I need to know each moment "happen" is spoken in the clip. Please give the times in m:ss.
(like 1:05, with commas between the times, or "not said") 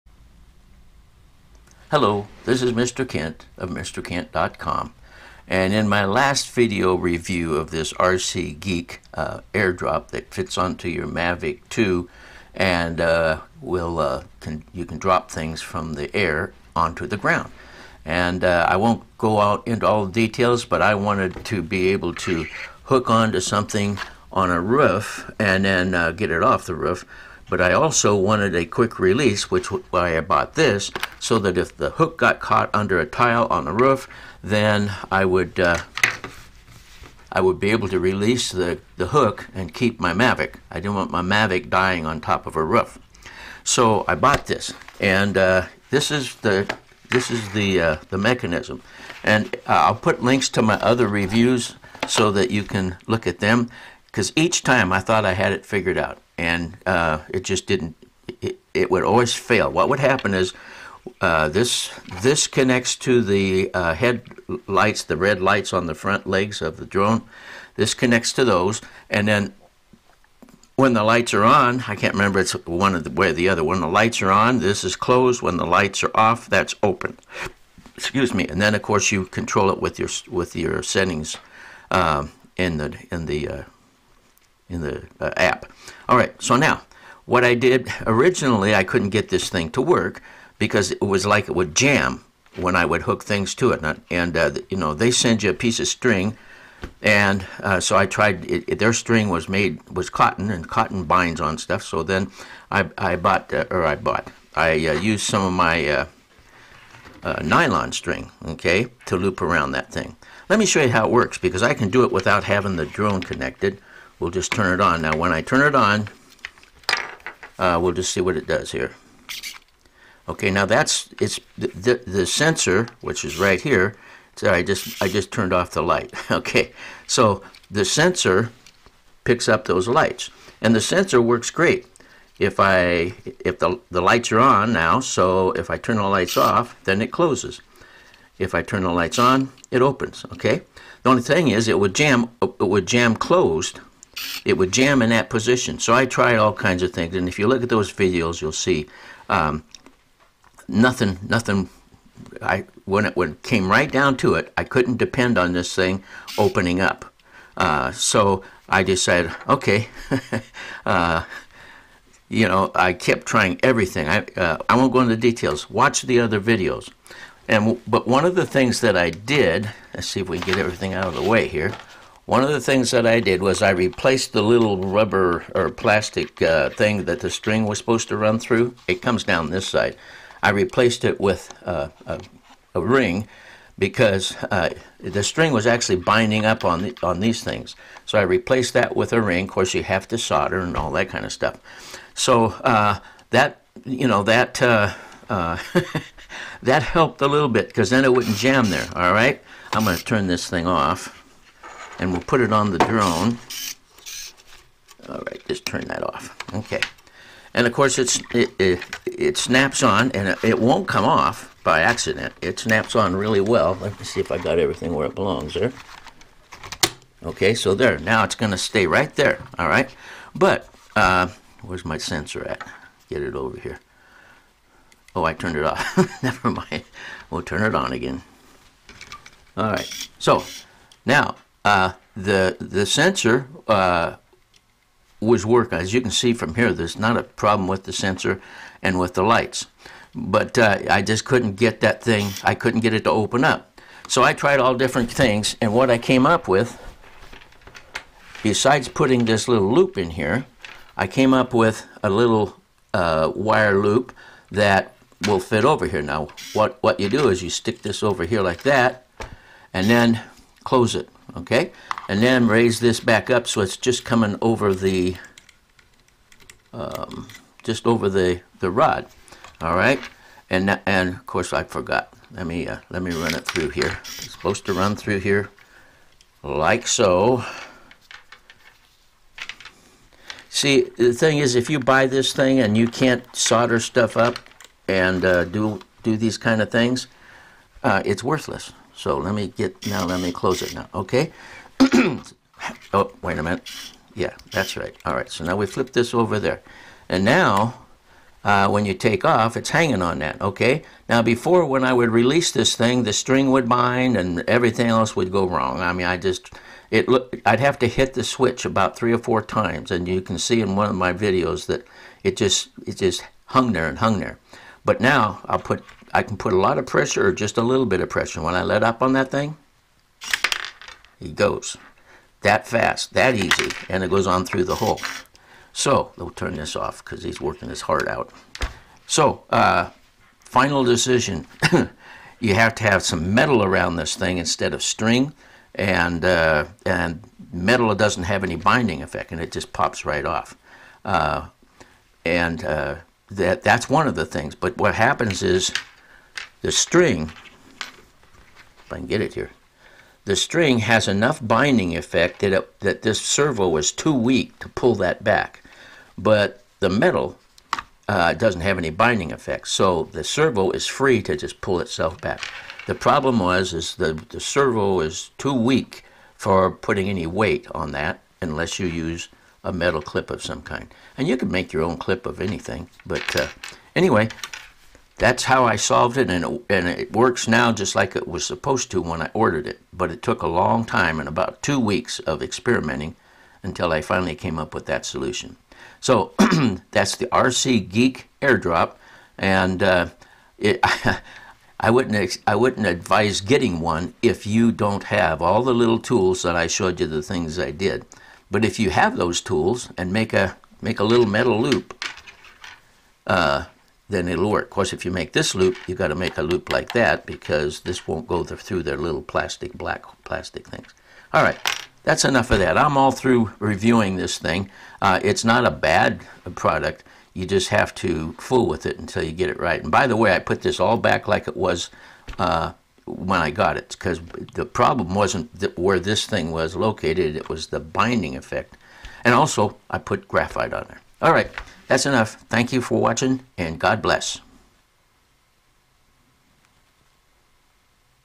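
0:59, 5:44.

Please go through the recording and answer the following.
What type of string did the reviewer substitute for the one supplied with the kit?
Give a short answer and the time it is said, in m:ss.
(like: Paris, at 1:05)
nylon, at 1:47.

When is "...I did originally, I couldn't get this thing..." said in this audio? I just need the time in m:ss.
1:27.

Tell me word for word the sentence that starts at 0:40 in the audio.
I didn't want my Mavic dying on top of a roof.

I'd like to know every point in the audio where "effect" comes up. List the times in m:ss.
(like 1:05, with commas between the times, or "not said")
5:39, 5:51, 5:59, 7:08.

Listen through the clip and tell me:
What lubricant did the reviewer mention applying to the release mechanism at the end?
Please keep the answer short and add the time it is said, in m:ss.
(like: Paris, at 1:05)
graphite, at 7:10.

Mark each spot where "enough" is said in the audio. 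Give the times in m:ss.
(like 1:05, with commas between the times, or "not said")
5:51, 6:52, 7:12.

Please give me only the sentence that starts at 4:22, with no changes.
And then raise this back up so it's just coming over the, um, just over the, the rod, all right?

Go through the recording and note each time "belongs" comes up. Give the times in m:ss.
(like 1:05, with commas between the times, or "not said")
3:35.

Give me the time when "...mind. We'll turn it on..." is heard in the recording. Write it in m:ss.
3:46.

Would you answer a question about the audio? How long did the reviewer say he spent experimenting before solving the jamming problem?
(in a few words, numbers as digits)
2 weeks.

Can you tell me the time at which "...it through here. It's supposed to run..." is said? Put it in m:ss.
4:33.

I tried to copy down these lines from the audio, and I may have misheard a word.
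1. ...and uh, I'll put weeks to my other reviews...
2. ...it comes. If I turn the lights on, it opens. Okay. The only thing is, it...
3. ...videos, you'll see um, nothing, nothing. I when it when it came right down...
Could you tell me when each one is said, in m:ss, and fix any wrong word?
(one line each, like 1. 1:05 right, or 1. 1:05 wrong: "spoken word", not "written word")
1. 0:49 wrong: "links", not "weeks"
2. 2:17 wrong: "closes", not "comes"
3. 2:27 right.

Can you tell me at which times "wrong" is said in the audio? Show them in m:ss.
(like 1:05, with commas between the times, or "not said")
5:05.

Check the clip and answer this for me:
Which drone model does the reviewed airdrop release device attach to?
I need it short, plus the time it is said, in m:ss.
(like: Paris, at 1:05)
Mavic 2, at 0:11.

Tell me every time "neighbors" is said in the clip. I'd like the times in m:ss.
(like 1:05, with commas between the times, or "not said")
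not said.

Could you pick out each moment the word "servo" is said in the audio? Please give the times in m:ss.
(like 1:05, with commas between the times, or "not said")
5:53, 6:00, 6:04.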